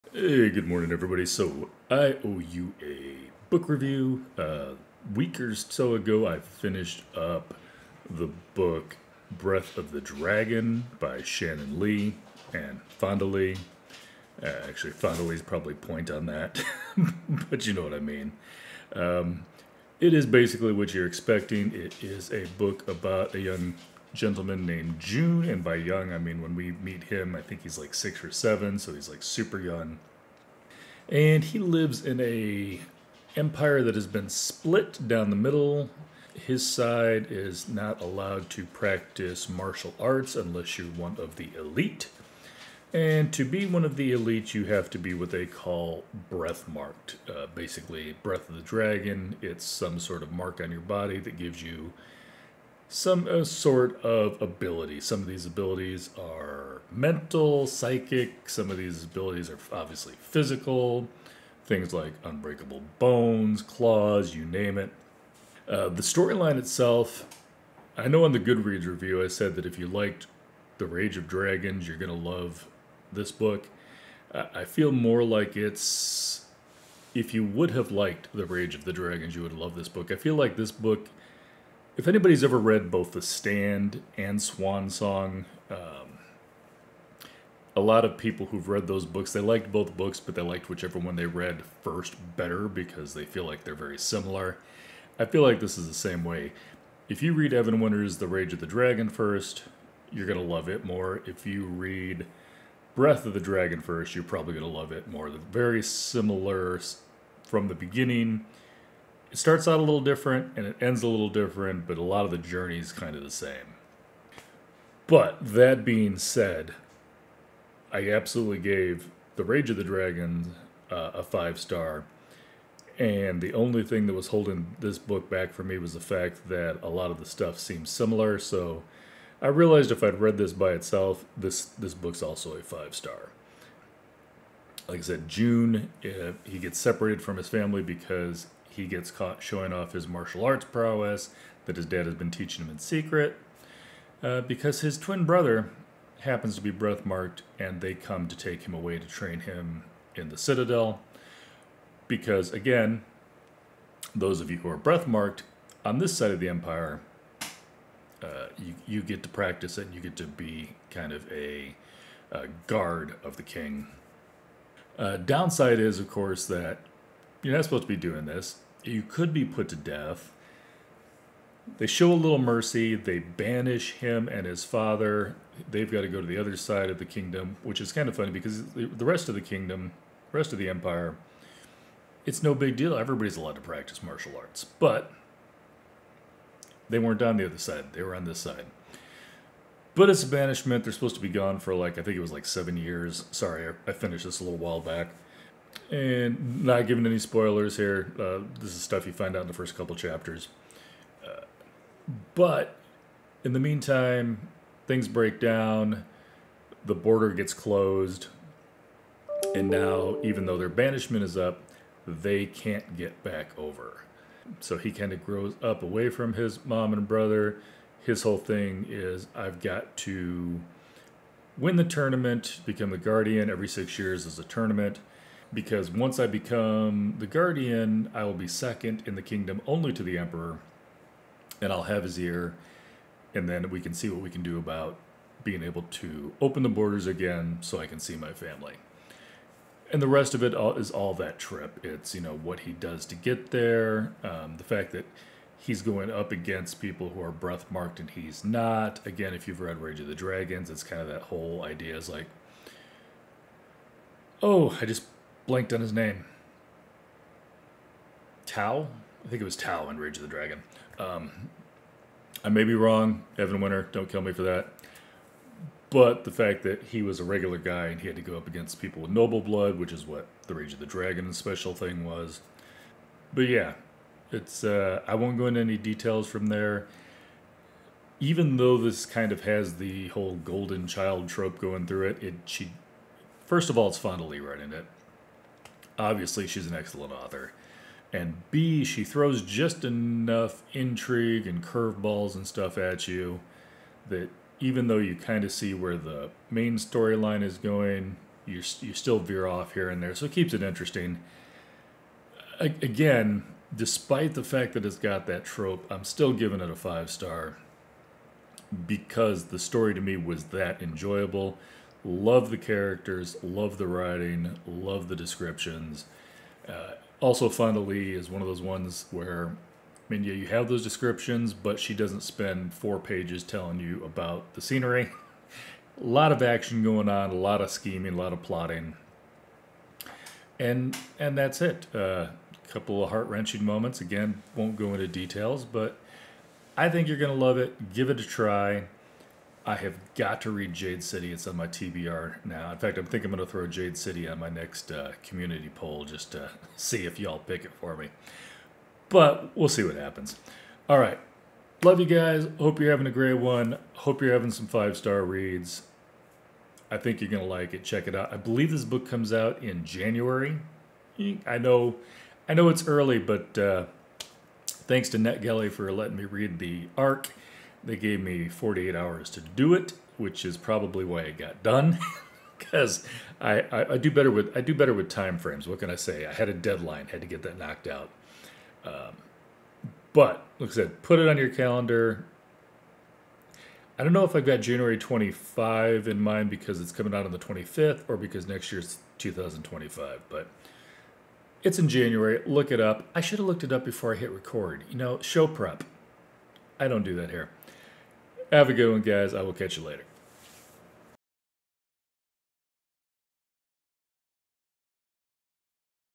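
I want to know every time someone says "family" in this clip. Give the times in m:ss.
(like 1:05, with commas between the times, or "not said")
2:17, 3:58.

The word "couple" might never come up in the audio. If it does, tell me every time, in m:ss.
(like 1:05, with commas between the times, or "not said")
3:19, 5:32.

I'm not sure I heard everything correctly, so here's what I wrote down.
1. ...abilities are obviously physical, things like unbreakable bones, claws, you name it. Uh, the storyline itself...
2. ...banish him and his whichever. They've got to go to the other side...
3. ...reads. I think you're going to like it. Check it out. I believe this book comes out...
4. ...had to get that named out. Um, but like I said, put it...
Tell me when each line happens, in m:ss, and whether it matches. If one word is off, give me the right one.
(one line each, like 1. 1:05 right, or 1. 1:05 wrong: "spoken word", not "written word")
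1. 0:59 right
2. 2:53 wrong: "father", not "whichever"
3. 5:55 right
4. 6:17 wrong: "knocked", not "named".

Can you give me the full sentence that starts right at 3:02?
Everybody's allowed to practice martial arts.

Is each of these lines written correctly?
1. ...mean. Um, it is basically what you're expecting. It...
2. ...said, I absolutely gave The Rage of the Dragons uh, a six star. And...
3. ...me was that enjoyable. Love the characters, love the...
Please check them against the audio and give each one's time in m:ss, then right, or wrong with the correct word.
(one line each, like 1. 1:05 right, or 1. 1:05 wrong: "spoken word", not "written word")
1. 0:17 right
2. 1:56 wrong: "five", not "six"
3. 5:10 right.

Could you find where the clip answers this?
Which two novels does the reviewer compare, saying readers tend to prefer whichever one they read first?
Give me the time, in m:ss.
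1:23.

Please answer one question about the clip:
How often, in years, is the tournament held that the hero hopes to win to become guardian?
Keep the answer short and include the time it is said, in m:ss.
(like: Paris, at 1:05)
6, at 3:43.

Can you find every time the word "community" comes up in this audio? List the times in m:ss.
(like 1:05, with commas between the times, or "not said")
5:45.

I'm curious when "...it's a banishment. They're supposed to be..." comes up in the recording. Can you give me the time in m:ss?
3:10.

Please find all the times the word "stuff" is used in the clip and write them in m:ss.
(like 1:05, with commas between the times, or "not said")
2:07, 3:18, 4:52.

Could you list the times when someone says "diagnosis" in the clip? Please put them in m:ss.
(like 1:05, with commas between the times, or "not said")
not said.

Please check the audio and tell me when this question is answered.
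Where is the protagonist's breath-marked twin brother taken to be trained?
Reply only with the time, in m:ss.
2:30.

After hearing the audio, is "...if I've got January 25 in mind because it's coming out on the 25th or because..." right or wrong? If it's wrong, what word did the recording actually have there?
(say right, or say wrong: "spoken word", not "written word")
right.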